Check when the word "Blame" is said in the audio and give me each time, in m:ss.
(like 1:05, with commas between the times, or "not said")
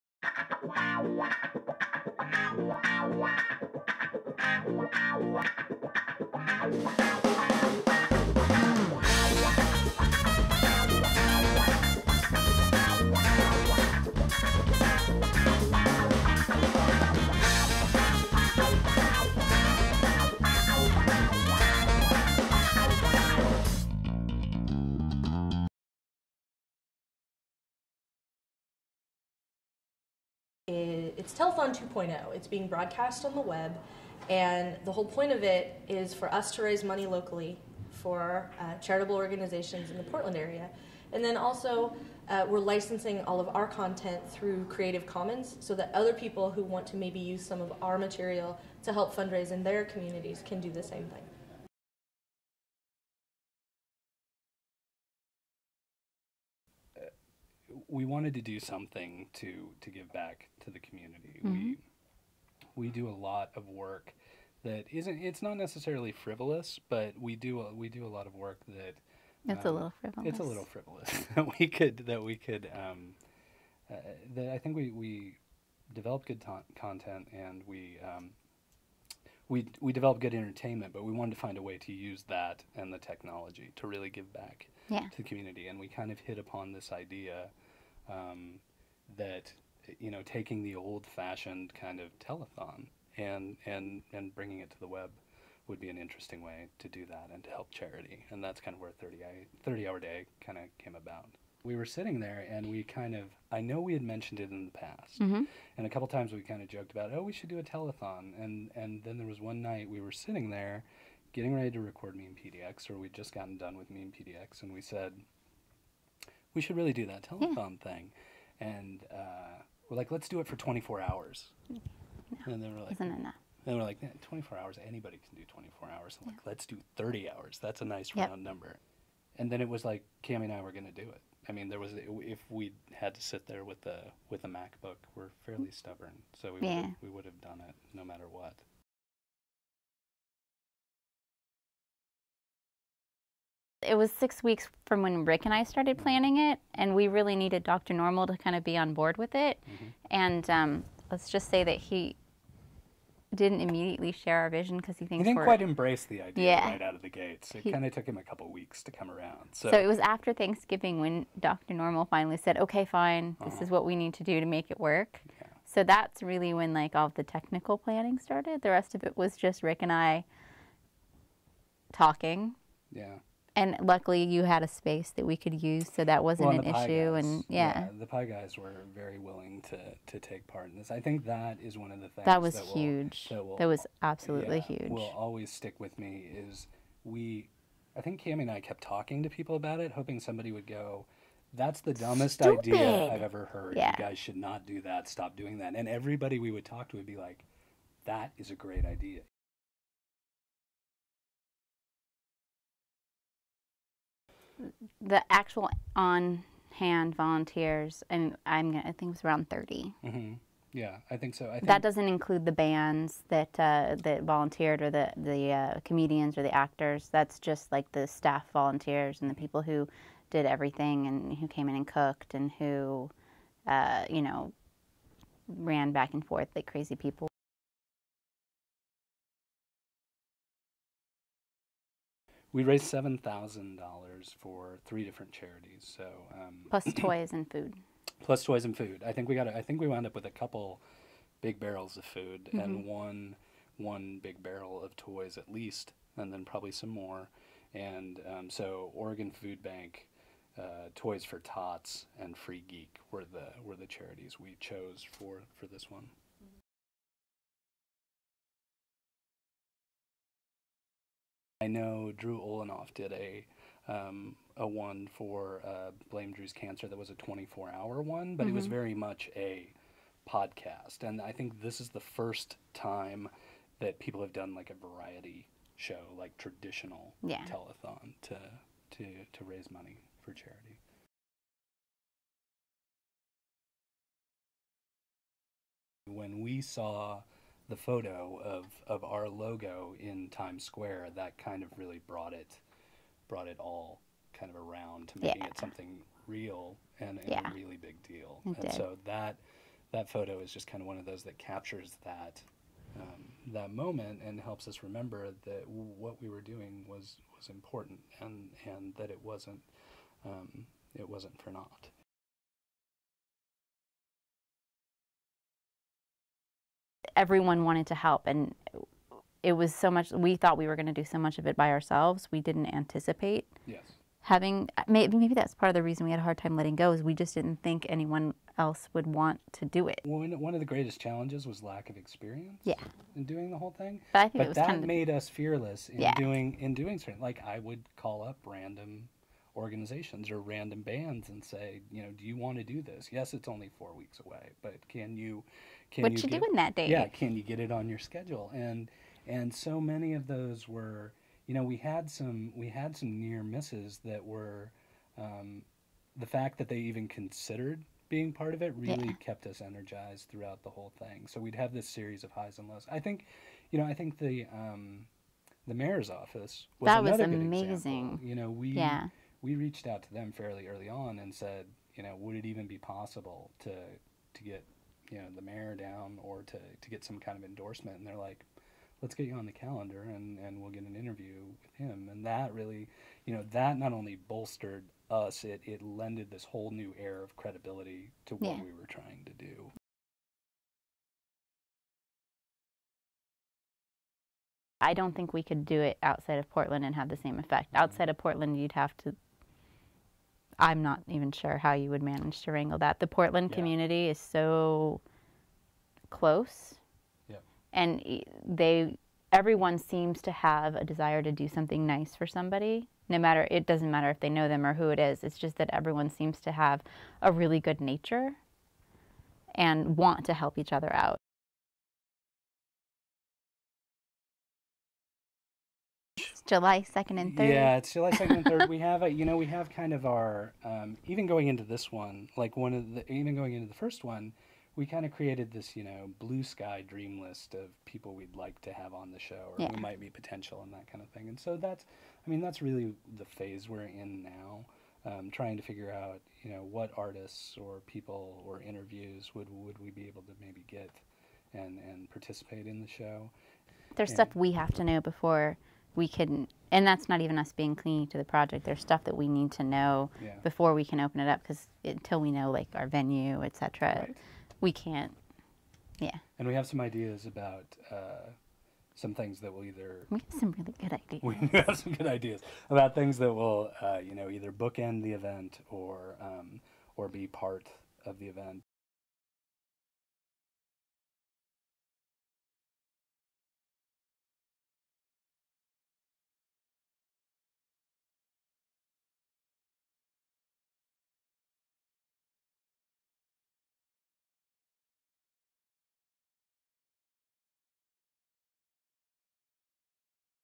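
4:26.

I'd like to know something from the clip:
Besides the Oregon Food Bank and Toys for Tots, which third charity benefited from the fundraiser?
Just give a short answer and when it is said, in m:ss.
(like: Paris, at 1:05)
Free Geek, at 4:12.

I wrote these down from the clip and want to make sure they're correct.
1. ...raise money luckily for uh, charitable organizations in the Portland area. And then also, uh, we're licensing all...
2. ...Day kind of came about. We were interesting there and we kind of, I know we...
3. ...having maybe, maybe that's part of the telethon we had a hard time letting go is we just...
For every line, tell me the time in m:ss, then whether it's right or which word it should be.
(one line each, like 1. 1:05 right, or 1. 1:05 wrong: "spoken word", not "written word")
1. 0:36 wrong: "locally", not "luckily"
2. 1:39 wrong: "sitting", not "interesting"
3. 5:24 wrong: "reason", not "telethon".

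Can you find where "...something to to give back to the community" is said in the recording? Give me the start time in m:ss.
0:58.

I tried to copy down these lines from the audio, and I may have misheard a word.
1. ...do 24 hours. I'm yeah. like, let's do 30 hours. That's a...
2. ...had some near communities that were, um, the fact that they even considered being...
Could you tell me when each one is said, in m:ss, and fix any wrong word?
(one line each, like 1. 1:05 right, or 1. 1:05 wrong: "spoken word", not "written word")
1. 2:05 right
2. 5:52 wrong: "misses", not "communities".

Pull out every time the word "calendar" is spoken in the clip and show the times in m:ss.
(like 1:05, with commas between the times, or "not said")
6:19.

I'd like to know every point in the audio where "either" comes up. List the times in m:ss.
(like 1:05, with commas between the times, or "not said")
7:49, 7:54.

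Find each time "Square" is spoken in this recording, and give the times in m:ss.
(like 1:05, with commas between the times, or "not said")
4:50.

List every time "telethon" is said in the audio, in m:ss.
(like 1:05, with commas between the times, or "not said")
0:31, 1:32, 1:47, 1:57, 4:37.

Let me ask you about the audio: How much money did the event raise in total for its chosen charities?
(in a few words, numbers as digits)
$7,000.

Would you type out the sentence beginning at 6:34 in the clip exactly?
I don't think we could do it outside of Portland and have the same effect.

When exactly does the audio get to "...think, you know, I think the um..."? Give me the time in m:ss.
6:02.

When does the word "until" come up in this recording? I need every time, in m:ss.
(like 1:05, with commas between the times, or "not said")
7:41.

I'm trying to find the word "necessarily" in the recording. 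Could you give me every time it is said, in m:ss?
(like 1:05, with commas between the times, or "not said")
1:05.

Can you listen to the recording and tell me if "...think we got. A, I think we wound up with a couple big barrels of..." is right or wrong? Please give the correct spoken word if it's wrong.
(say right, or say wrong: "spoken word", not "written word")
right.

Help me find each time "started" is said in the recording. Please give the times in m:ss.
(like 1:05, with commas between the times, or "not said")
2:25, 2:48.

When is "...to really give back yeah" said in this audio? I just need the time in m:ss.
1:23.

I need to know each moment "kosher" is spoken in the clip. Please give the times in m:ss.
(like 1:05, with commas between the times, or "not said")
not said.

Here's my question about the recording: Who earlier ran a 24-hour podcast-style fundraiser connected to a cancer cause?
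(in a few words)
Drew Olanoff.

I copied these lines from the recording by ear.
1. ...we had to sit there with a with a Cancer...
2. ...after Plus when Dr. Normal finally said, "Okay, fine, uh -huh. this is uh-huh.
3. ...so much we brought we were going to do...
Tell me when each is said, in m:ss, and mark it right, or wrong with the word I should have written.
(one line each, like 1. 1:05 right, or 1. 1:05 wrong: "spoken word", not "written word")
1. 2:12 wrong: "MacBook", not "Cancer"
2. 2:39 wrong: "Thanksgiving", not "Plus"
3. 5:19 wrong: "thought", not "brought".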